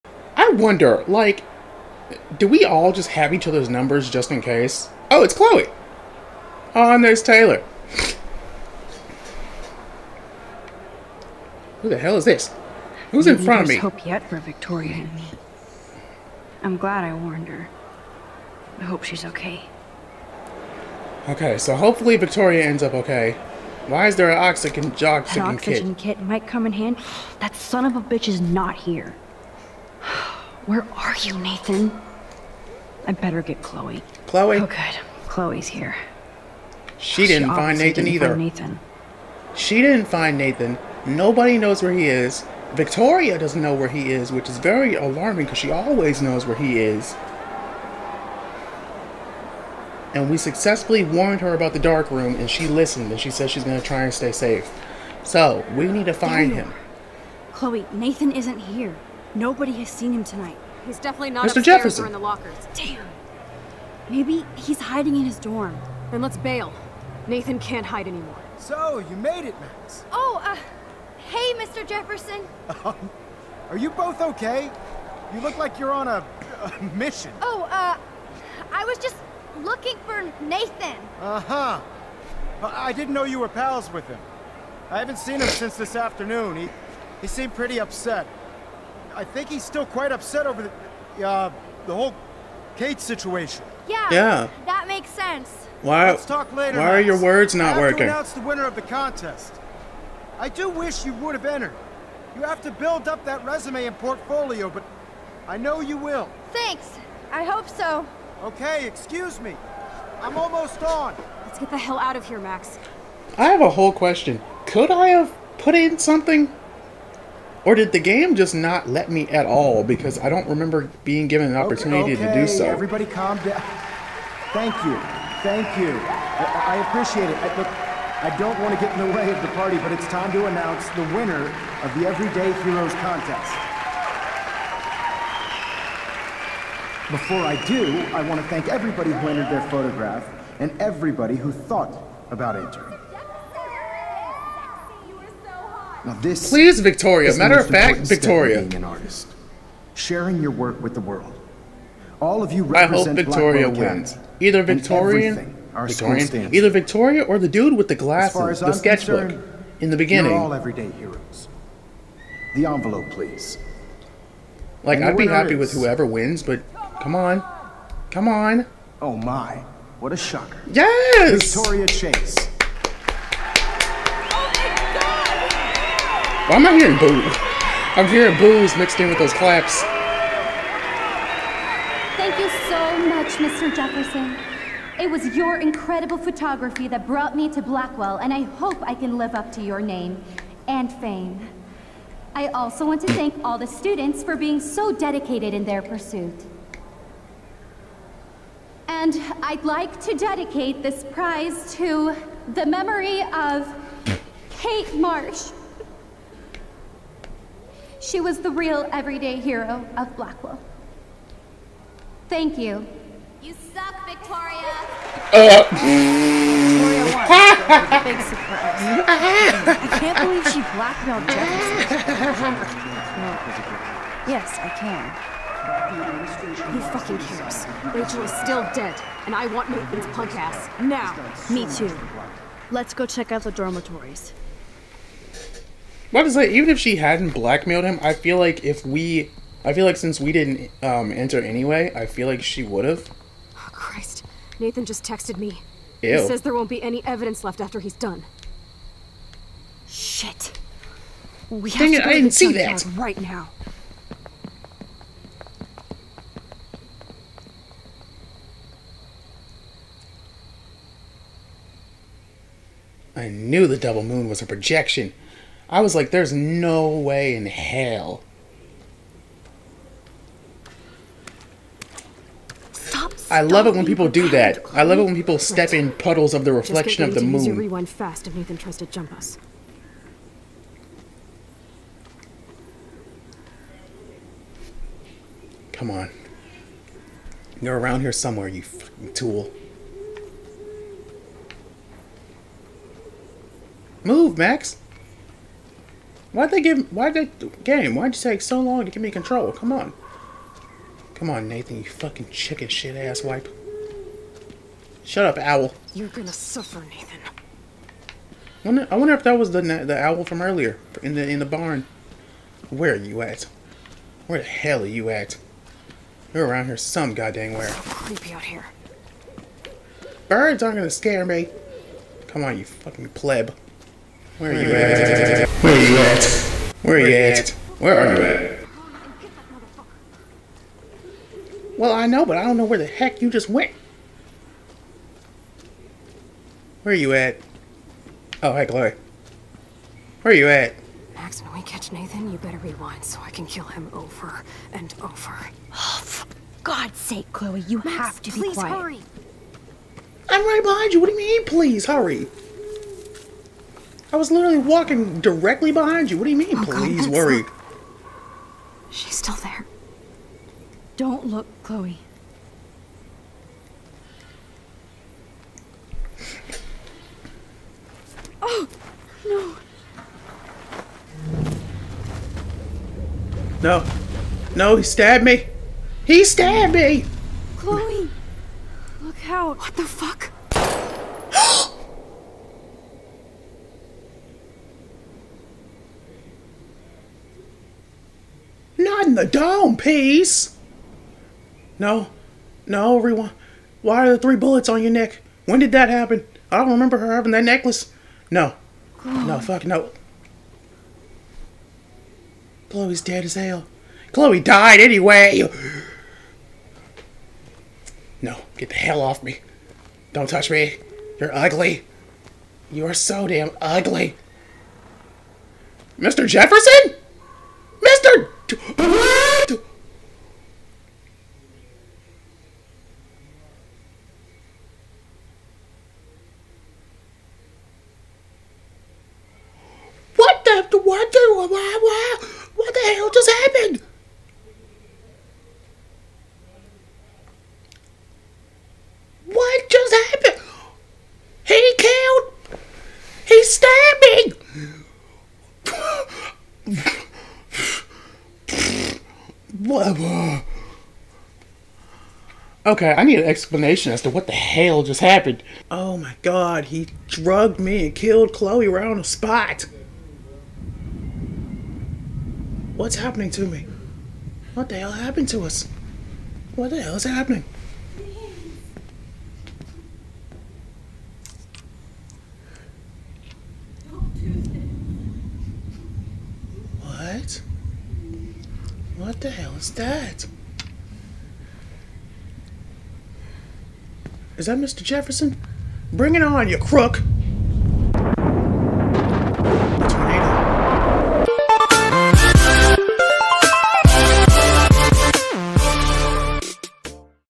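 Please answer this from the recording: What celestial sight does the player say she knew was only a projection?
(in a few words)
The double moon.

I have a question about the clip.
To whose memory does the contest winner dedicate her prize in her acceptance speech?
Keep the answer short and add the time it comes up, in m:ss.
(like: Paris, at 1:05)
Kate Marsh, at 3:24.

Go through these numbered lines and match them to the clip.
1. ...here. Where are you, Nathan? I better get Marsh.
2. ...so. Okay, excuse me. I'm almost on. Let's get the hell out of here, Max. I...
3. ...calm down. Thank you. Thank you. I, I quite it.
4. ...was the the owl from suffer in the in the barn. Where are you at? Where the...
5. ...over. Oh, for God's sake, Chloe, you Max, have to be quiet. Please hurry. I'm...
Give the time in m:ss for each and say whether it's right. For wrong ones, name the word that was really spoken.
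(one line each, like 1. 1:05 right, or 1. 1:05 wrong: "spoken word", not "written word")
1. 0:28 wrong: "Chloe", not "Marsh"
2. 1:47 right
3. 2:03 wrong: "appreciate", not "quite"
4. 5:09 wrong: "earlier", not "suffer"
5. 5:45 right.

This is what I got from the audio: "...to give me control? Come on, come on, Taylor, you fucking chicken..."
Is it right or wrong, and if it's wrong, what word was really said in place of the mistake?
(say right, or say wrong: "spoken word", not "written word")
wrong: "Nathan", not "Taylor".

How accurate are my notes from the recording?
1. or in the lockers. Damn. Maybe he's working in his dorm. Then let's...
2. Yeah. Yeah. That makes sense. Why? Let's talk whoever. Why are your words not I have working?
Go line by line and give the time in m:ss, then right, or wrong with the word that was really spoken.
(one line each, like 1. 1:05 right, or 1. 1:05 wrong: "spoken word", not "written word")
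1. 1:02 wrong: "hiding", not "working"
2. 1:33 wrong: "later", not "whoever".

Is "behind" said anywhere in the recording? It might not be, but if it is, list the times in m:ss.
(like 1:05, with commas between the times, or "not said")
5:50, 5:55.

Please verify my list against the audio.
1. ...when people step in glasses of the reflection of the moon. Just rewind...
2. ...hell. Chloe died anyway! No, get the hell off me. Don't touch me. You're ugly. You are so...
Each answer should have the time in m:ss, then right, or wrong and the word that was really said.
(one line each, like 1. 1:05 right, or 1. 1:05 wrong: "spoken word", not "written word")
1. 4:35 wrong: "puddles", not "glasses"
2. 6:43 right.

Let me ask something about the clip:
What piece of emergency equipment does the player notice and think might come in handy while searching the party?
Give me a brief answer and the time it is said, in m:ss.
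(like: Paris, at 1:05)
Oxygen kit, at 0:25.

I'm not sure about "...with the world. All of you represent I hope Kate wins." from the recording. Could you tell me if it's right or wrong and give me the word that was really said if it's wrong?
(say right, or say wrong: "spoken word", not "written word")
wrong: "Victoria", not "Kate".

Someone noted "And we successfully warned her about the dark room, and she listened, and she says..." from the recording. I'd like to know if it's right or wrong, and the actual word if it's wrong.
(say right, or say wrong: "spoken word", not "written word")
right.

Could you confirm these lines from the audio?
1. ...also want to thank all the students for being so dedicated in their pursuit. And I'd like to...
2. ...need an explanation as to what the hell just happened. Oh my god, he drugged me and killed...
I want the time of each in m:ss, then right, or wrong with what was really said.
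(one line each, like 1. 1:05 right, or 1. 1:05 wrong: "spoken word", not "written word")
1. 3:12 right
2. 7:33 right.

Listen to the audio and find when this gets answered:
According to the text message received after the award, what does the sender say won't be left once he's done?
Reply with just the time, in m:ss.
4:06.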